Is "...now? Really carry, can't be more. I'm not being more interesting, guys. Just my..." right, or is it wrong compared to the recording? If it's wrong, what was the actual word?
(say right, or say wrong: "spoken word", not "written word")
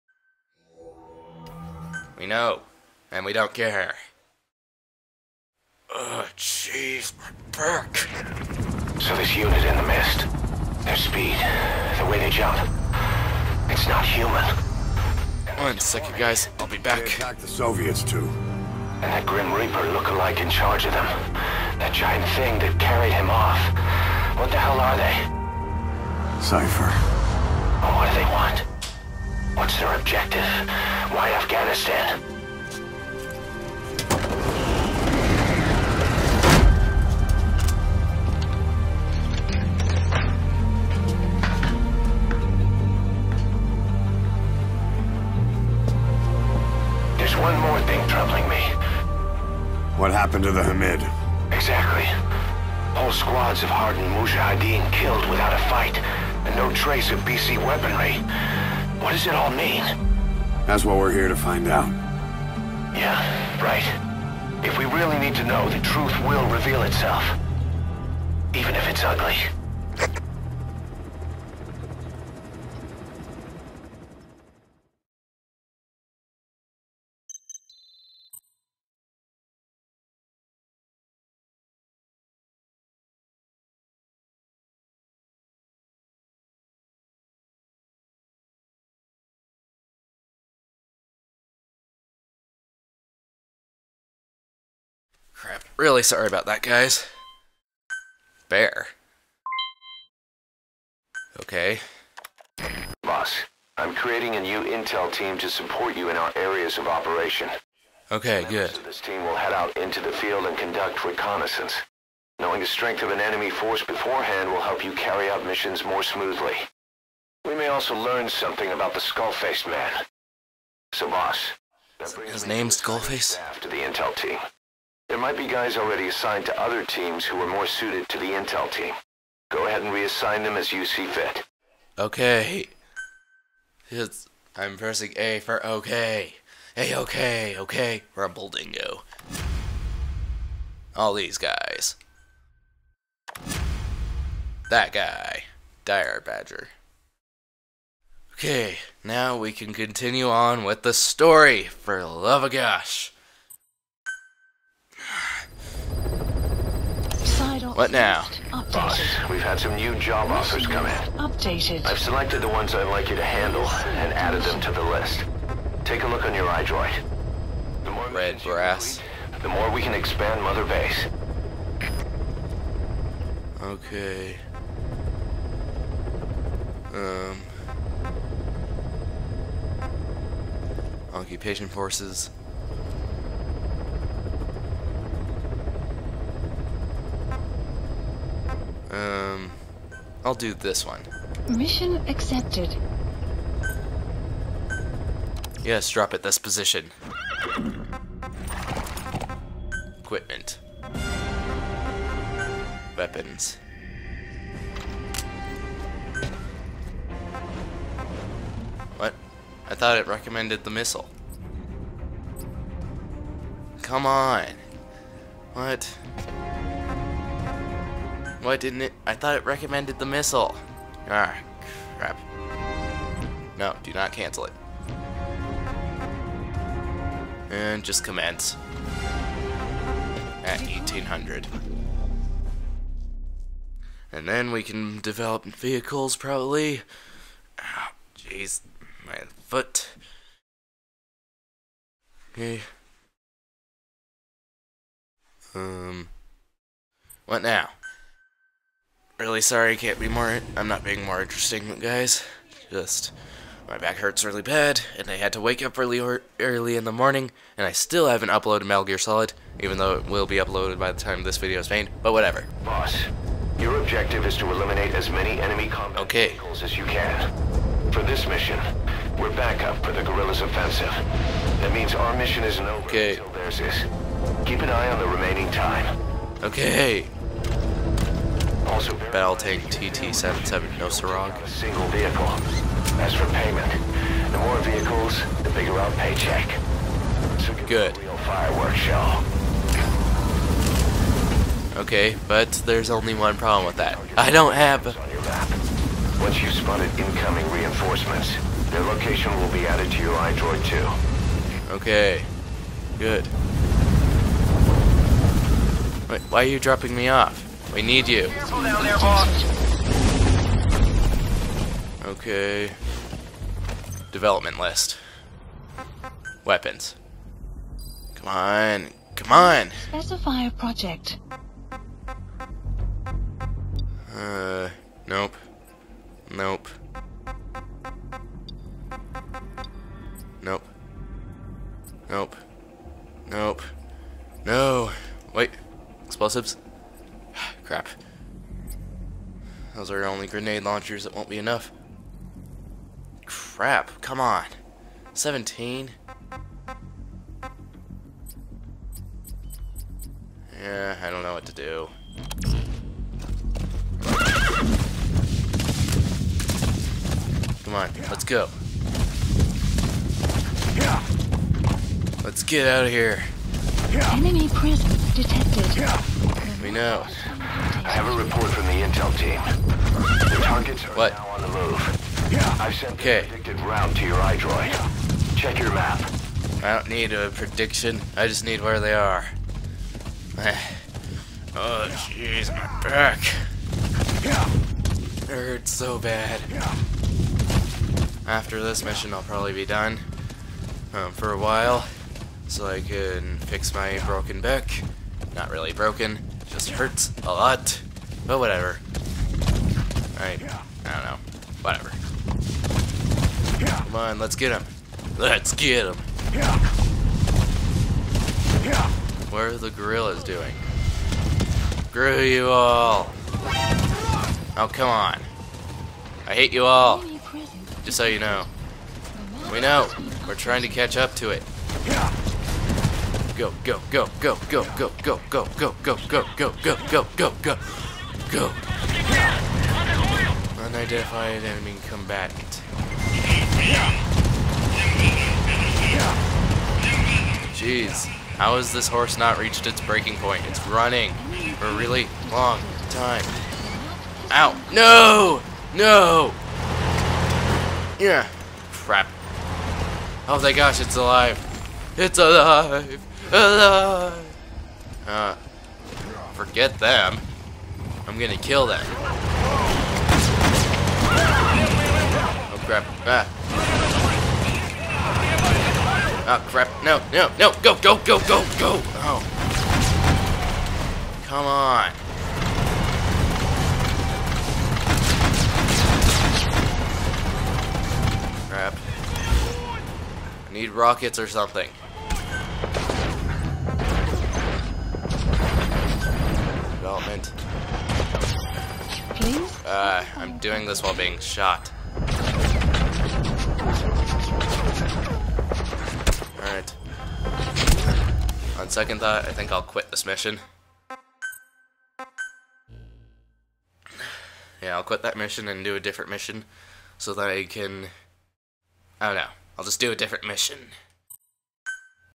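wrong: "sorry", not "carry".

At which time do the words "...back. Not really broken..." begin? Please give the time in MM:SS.
06:34.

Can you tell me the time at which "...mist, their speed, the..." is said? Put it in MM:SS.
00:09.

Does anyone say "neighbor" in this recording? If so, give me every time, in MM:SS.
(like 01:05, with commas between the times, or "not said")
not said.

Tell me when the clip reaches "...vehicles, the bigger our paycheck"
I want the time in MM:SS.
04:44.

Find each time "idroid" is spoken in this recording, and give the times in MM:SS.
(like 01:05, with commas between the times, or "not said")
02:46, 05:00, 06:14.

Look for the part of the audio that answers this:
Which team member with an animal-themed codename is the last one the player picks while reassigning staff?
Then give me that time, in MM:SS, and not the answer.
02:25.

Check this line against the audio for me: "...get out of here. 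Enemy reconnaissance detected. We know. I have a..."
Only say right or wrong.
wrong.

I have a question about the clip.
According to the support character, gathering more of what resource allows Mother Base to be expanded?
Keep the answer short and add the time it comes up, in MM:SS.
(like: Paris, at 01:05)
Red brass, at 02:48.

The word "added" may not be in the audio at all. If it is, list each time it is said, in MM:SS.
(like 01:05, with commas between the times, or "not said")
02:44, 04:59.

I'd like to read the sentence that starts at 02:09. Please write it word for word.
Go ahead and reassign them as you see fit.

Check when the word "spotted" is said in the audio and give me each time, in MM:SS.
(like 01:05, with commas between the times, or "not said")
04:56.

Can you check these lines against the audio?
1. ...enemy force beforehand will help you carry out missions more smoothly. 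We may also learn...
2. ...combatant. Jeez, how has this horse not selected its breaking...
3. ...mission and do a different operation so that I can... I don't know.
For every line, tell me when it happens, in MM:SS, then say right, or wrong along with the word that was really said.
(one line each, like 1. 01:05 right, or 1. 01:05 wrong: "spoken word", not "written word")
1. 01:53 right
2. 07:11 wrong: "reached", not "selected"
3. 08:25 wrong: "mission", not "operation".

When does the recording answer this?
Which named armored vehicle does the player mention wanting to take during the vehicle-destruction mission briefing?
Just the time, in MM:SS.
04:39.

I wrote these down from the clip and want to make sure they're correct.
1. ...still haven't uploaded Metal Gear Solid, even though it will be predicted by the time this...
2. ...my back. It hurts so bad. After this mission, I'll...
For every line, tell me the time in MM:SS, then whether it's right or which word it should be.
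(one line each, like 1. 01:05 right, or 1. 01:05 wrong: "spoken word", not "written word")
1. 04:17 wrong: "uploaded", not "predicted"
2. 06:22 right.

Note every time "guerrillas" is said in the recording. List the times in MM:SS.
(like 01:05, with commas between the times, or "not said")
04:30, 06:49.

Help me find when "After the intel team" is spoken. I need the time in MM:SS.
02:03.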